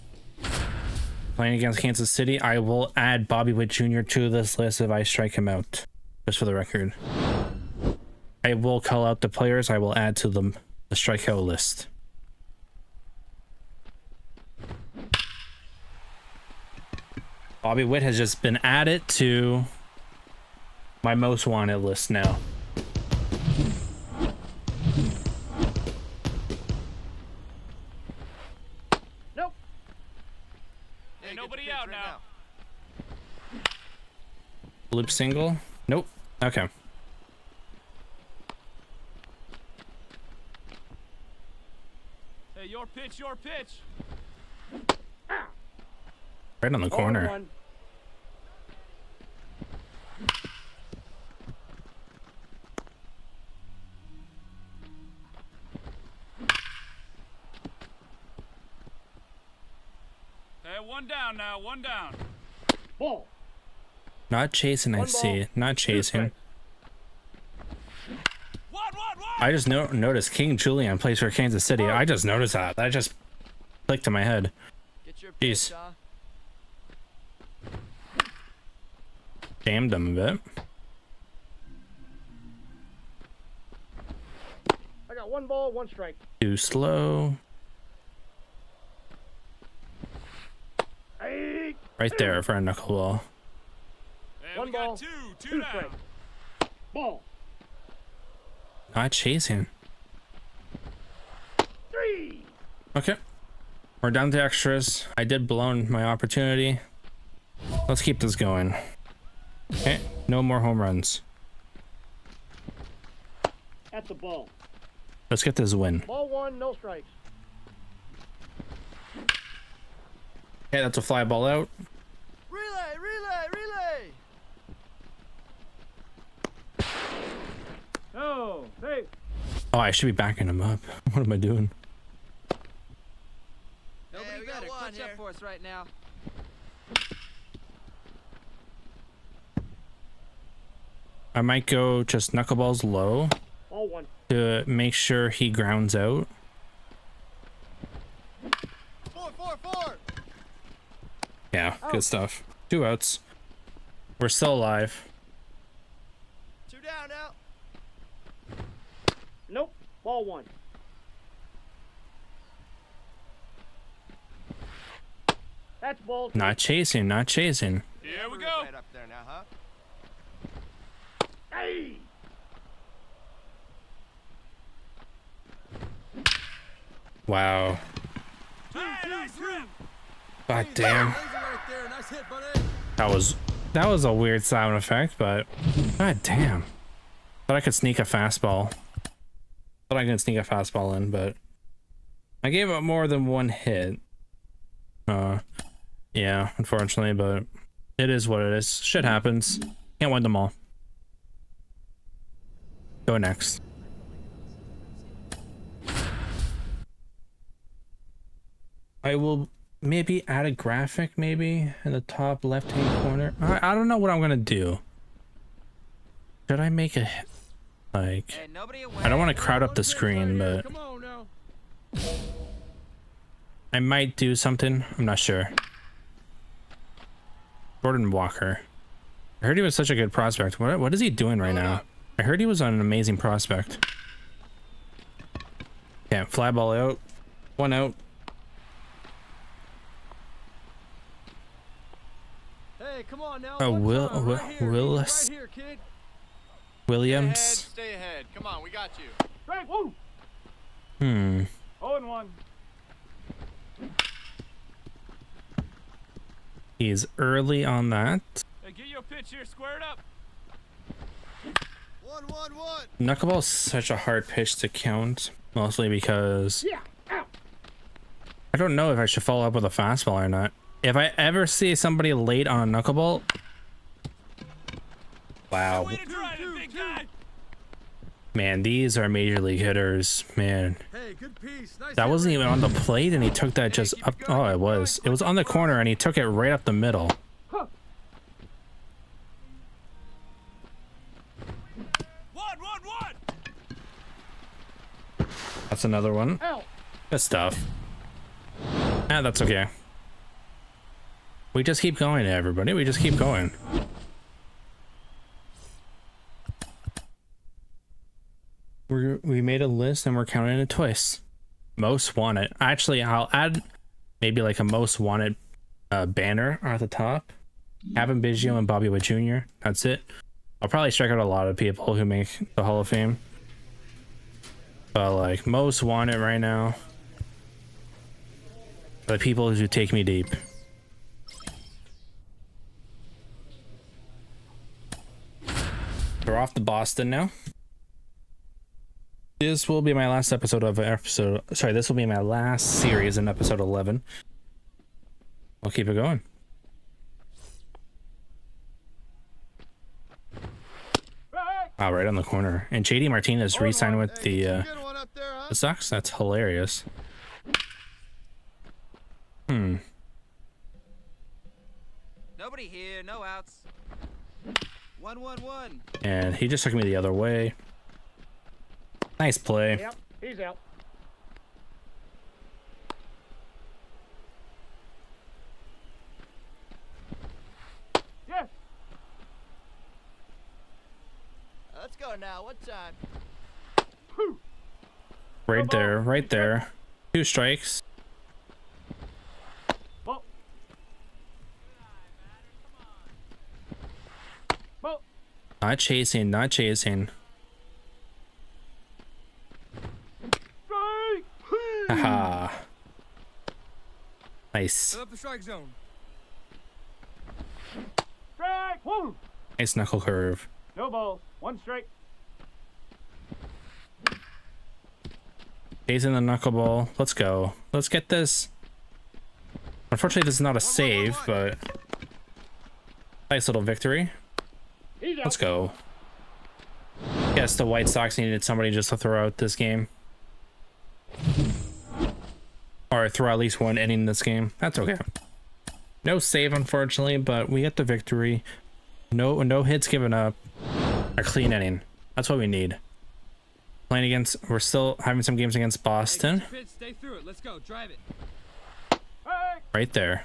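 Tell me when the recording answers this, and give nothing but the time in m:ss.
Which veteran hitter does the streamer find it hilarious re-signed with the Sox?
5:52.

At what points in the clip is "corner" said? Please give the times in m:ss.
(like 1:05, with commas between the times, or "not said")
0:46, 3:33, 4:45, 5:52.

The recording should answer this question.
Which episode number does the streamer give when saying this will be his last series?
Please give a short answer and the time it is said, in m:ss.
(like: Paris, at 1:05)
11, at 5:43.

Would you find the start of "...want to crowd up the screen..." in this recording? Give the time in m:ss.
3:39.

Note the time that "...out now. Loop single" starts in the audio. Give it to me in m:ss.
0:31.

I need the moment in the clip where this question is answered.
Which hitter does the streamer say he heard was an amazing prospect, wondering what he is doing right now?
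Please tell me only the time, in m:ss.
3:47.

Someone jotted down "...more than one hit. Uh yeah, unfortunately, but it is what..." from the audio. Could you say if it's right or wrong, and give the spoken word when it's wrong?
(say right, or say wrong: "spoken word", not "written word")
right.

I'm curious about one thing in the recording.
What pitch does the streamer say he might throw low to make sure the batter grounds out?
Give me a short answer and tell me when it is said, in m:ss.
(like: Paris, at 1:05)
knuckleballs, at 2:22.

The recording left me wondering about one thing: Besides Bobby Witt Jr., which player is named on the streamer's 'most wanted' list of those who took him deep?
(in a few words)
Kevin Biggio.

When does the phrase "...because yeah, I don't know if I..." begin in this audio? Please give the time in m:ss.
4:25.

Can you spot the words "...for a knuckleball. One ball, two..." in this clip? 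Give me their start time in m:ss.
1:32.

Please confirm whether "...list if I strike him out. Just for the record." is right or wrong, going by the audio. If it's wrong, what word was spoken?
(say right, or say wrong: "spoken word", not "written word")
right.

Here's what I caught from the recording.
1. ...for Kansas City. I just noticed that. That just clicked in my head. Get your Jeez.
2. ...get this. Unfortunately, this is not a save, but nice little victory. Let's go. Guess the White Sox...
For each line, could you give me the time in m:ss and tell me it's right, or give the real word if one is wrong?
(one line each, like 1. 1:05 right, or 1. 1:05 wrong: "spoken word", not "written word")
1. 1:11 right
2. 6:57 right.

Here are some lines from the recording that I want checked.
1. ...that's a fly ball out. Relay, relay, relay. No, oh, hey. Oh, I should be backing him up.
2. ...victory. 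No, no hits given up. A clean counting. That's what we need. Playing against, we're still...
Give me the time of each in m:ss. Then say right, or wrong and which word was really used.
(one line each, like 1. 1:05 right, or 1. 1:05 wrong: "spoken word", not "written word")
1. 2:00 right
2. 7:17 wrong: "inning", not "counting".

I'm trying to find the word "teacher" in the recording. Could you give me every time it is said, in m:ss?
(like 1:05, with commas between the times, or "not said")
not said.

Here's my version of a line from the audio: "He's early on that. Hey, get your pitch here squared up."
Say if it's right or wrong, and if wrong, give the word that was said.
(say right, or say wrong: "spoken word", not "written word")
right.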